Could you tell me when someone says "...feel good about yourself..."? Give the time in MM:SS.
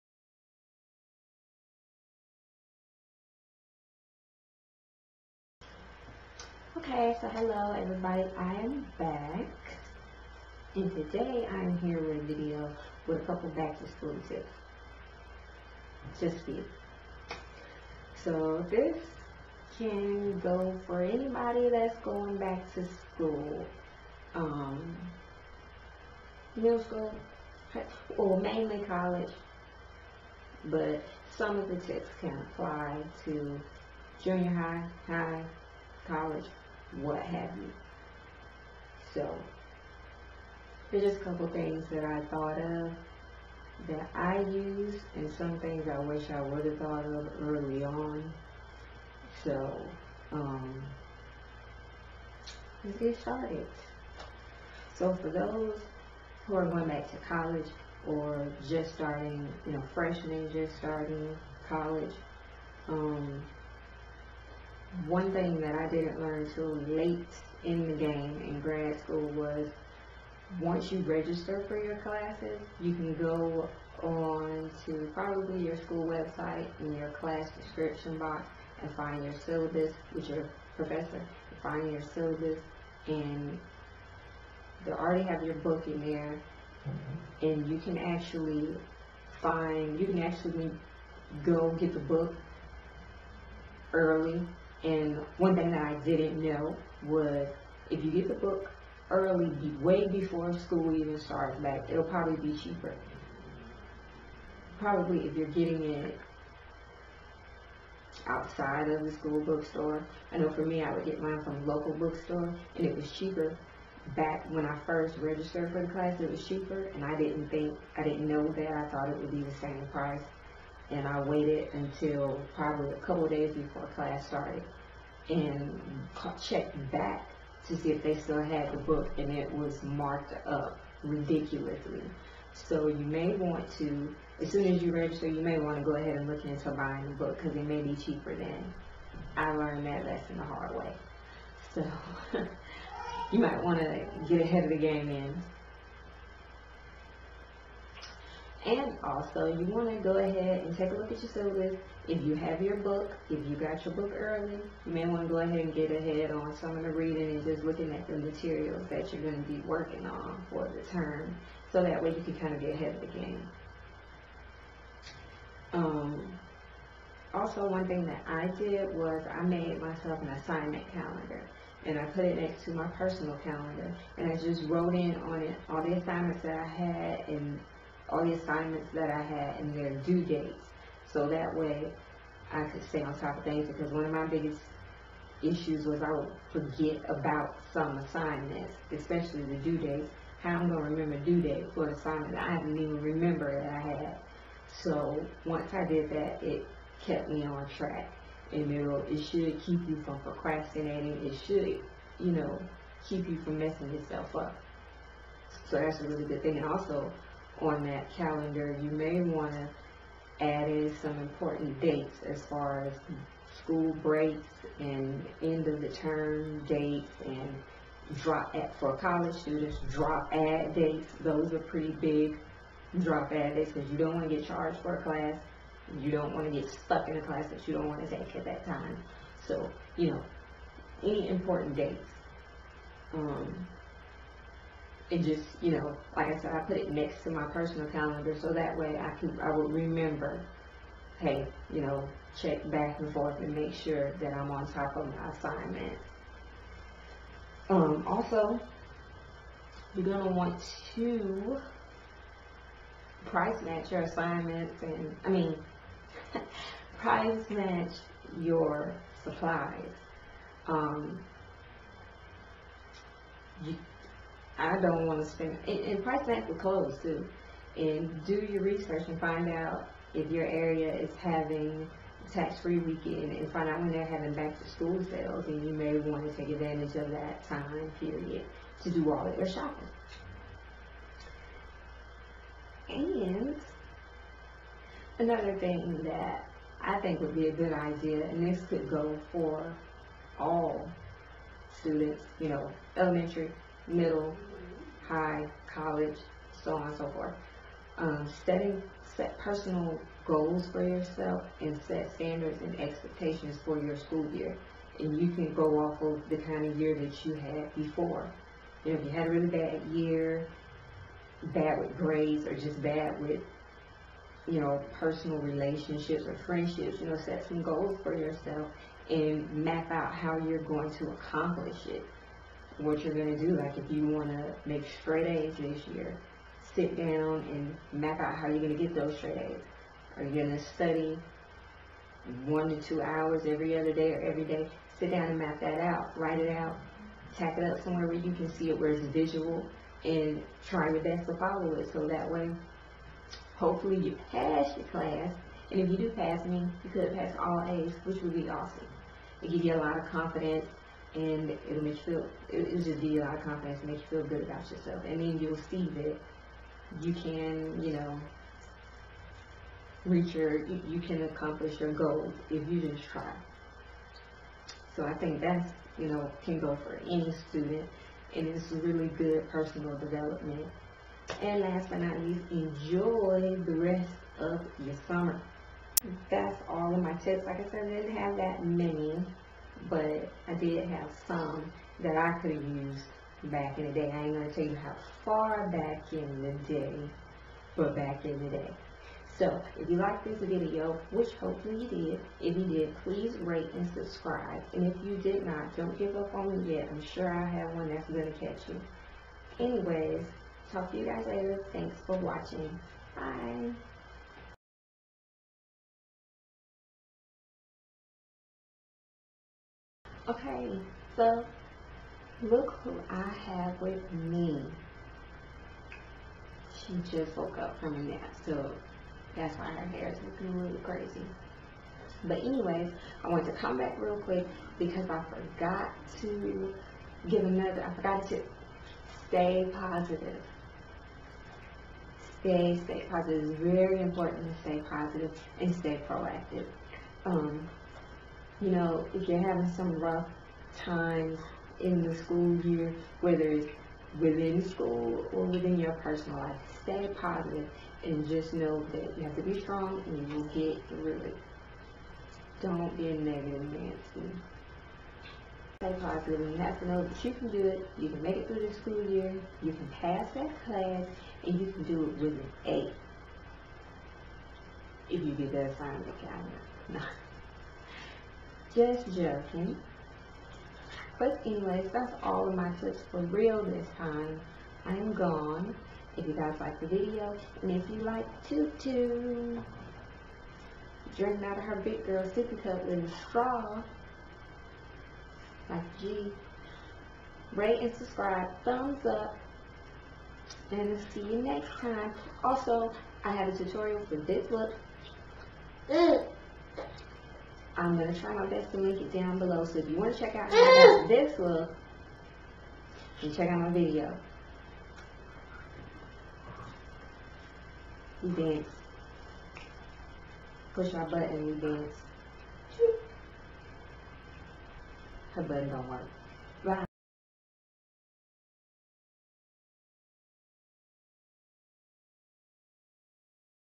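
05:54.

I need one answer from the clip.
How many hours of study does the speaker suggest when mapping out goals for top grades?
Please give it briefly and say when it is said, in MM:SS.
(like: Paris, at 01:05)
one to two hours, at 05:32.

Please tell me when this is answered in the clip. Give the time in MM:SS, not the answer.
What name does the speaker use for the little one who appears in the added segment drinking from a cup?
07:58.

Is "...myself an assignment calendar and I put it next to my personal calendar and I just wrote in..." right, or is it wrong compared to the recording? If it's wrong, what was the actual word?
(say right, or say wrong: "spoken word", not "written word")
right.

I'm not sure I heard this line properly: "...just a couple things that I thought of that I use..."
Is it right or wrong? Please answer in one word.
right.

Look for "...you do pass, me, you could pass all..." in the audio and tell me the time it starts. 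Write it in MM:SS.
05:45.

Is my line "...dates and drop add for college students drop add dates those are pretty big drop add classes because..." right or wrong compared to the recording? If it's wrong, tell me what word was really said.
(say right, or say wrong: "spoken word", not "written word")
wrong: "dates", not "classes".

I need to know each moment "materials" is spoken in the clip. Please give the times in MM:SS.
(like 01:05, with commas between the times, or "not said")
02:38.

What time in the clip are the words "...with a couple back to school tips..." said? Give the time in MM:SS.
00:13.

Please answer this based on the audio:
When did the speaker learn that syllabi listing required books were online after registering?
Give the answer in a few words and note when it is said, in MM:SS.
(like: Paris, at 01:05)
grad school, at 01:08.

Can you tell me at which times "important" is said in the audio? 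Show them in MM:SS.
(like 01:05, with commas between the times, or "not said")
03:31, 03:51, 07:14.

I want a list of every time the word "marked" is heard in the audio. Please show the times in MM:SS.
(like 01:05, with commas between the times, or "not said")
02:09.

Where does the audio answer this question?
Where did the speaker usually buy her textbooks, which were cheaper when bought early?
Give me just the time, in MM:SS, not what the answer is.
01:51.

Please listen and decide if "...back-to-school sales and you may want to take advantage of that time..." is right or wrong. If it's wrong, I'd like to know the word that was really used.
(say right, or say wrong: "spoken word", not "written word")
right.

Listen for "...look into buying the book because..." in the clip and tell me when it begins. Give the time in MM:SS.
02:16.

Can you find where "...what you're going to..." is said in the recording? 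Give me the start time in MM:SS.
05:22.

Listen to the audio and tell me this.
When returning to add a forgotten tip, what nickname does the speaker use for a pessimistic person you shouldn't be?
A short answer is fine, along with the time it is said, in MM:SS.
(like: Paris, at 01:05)
negative Nancy, at 07:33.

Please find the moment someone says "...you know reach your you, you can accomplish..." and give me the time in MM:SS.
05:57.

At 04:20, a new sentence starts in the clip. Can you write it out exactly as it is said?
Um, you, I don't want to spend, and, and price match the clothes too.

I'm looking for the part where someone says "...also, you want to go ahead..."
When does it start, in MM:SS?
02:29.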